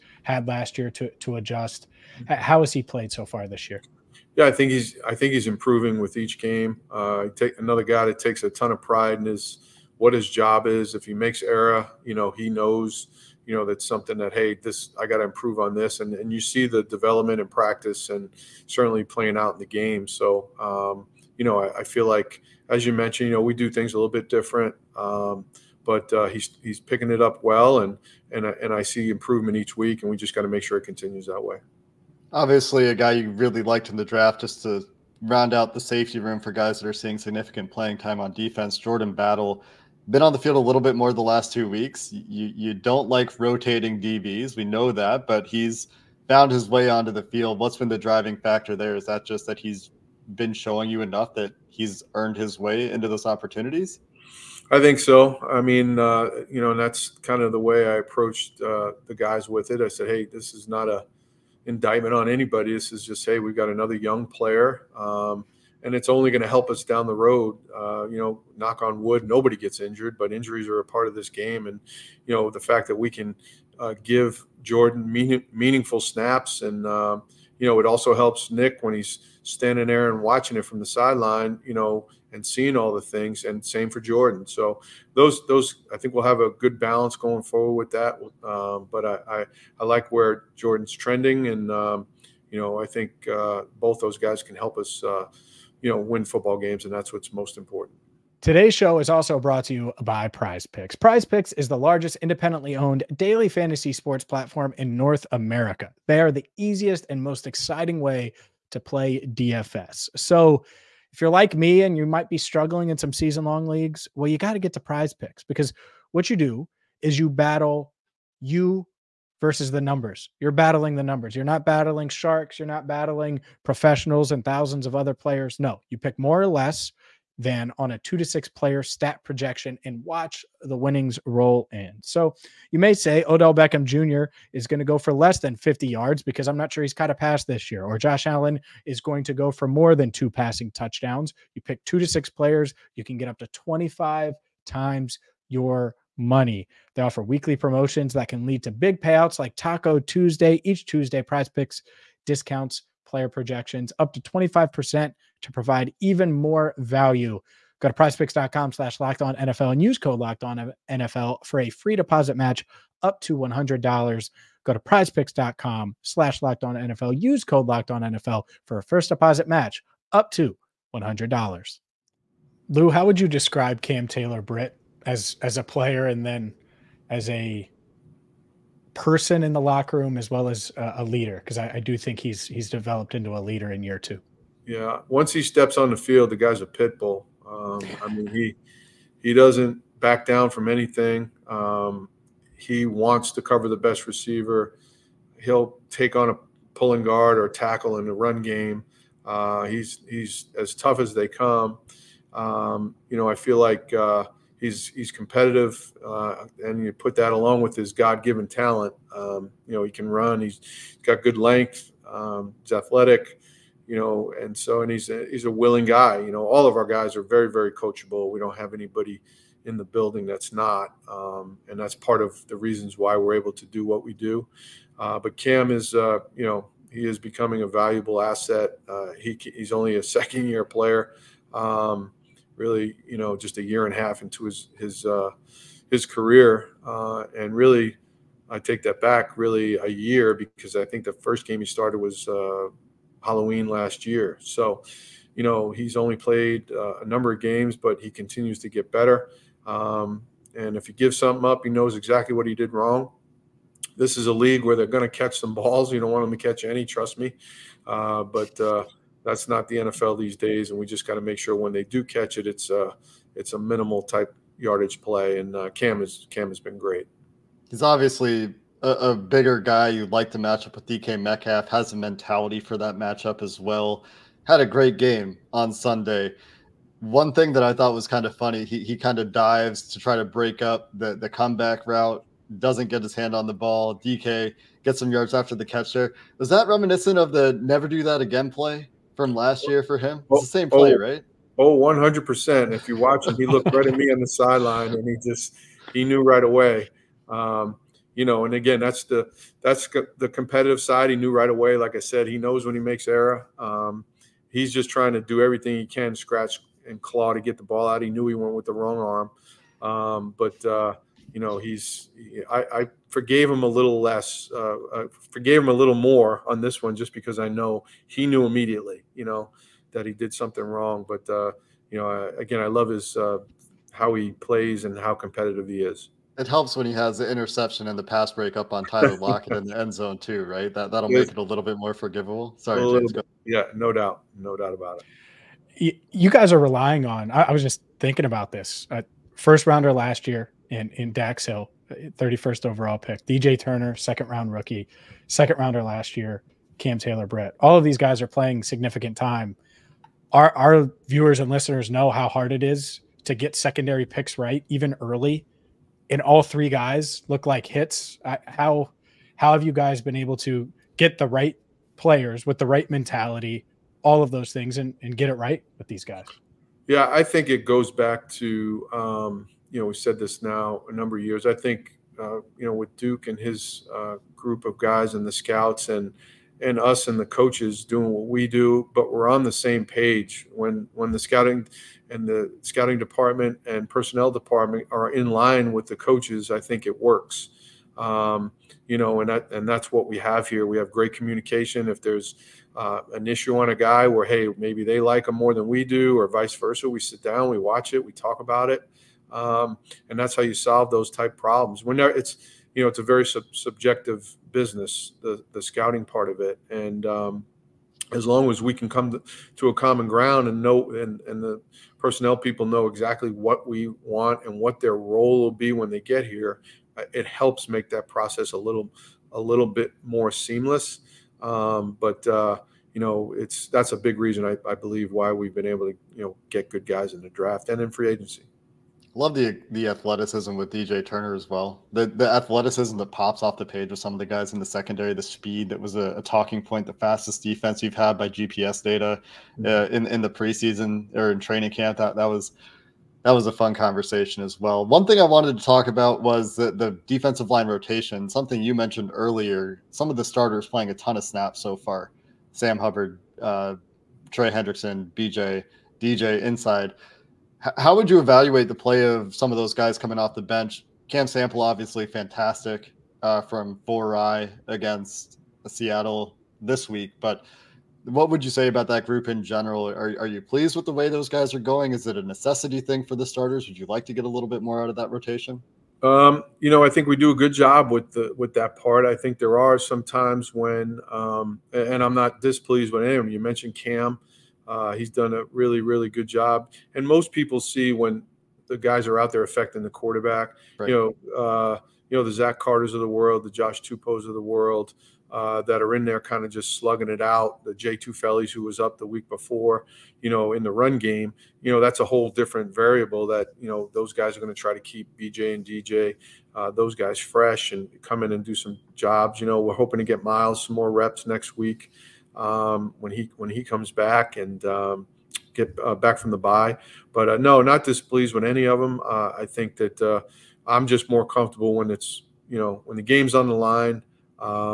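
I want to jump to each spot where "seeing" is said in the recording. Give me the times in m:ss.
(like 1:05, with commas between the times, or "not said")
0:36, 1:22.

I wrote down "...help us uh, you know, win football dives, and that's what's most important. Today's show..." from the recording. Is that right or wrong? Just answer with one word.
wrong.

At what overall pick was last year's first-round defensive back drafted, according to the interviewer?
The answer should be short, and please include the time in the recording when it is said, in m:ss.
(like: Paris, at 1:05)
31st, at 5:41.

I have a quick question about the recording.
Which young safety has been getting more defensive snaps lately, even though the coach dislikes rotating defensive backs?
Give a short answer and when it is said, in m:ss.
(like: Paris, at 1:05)
Jordan Battle, at 0:38.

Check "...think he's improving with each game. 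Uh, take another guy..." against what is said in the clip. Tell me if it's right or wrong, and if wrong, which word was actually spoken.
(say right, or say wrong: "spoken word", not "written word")
right.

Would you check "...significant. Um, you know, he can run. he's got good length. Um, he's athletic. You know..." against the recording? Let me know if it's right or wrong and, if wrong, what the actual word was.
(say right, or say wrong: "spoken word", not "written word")
wrong: "talent", not "significant".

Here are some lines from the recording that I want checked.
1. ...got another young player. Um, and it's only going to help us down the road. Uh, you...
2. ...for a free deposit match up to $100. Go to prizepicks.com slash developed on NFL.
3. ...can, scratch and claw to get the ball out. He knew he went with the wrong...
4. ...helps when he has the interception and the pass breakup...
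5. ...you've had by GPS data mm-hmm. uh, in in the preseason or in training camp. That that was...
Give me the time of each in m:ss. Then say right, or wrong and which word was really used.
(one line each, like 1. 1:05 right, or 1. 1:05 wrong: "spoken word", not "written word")
1. 1:03 right
2. 2:41 wrong: "locked", not "developed"
3. 5:05 right
4. 5:26 right
5. 7:17 right.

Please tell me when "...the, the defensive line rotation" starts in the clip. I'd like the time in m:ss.
7:26.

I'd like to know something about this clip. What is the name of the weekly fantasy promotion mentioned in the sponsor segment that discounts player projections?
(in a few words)
Taco Tuesday.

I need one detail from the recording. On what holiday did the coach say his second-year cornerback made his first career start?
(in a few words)
Halloween.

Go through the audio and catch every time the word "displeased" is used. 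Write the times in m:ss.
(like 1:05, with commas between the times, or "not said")
8:02, 8:37.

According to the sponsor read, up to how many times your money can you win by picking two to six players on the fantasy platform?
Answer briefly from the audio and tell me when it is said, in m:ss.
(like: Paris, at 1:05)
25, at 2:23.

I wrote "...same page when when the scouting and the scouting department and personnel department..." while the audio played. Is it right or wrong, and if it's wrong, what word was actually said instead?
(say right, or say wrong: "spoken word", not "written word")
right.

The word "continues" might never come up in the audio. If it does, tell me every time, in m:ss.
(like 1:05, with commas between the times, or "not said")
0:30, 4:08.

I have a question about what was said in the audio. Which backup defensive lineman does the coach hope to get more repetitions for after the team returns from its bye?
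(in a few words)
Myles.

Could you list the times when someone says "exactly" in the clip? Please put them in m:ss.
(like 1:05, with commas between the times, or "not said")
4:11, 6:52.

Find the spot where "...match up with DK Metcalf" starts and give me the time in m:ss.
4:30.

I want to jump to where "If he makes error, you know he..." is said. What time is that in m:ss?
0:10.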